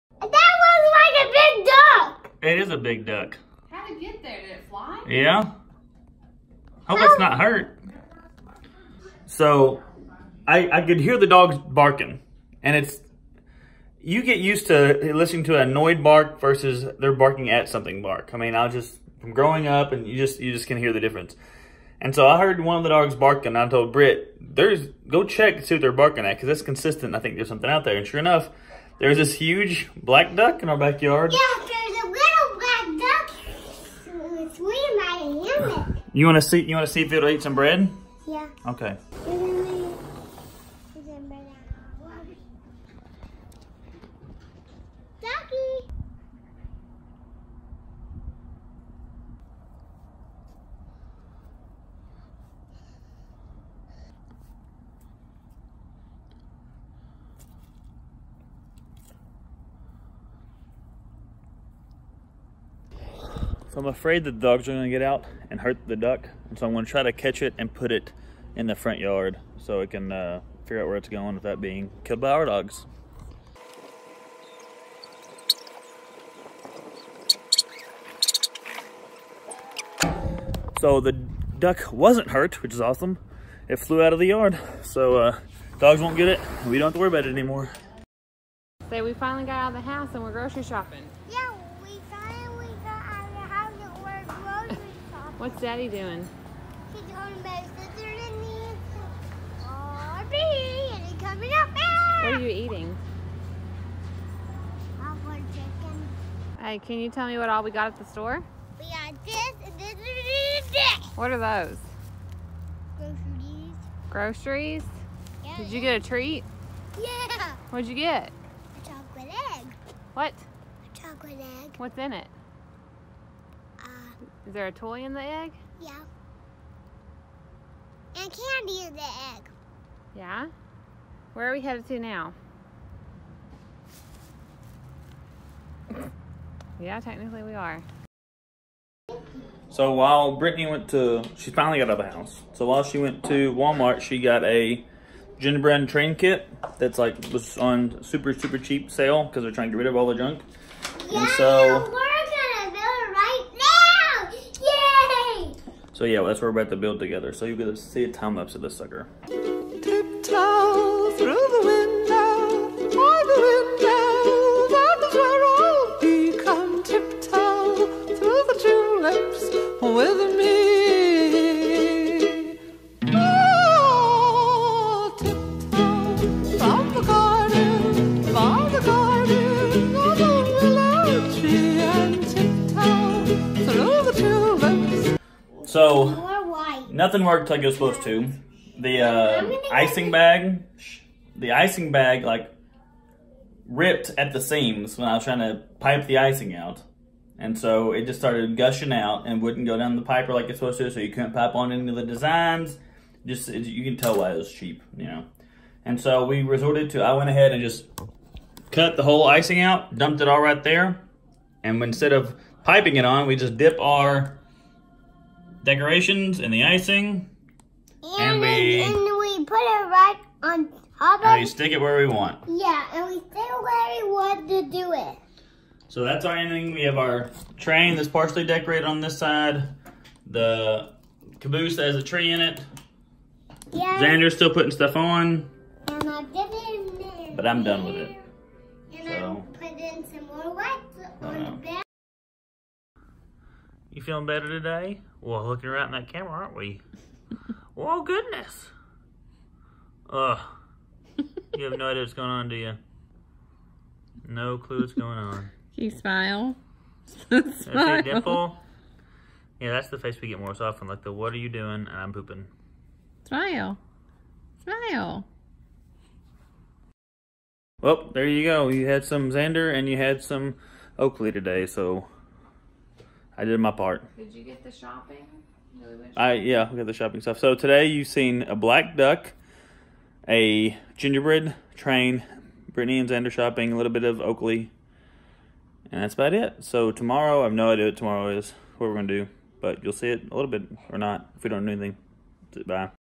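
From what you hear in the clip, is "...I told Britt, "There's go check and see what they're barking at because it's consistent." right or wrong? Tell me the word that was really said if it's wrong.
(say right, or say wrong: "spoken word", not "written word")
right.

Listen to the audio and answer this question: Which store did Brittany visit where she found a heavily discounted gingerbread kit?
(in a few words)
Walmart.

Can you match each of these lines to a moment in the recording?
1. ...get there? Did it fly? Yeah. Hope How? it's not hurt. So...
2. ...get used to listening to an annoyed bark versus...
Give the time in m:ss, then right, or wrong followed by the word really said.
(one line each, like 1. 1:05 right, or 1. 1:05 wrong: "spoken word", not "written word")
1. 0:04 right
2. 0:14 right.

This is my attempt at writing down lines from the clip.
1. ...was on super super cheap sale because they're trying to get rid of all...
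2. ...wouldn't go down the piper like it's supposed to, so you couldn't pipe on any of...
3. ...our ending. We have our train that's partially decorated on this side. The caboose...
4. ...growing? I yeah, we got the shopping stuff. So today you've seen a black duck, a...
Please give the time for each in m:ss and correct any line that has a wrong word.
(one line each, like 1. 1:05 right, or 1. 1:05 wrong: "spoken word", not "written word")
1. 2:27 right
2. 3:19 right
3. 3:46 right
4. 4:34 wrong: "shopping", not "growing".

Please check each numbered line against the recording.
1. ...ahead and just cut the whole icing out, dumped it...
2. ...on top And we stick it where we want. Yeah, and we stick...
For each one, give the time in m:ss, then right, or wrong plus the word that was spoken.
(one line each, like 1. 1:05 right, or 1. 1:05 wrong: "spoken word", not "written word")
1. 3:27 right
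2. 3:40 right.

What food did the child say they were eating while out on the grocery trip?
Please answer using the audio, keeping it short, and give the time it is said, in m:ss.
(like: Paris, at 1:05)
Popcorn chicken, at 1:44.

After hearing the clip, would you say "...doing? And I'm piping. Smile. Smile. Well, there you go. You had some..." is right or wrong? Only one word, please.
wrong.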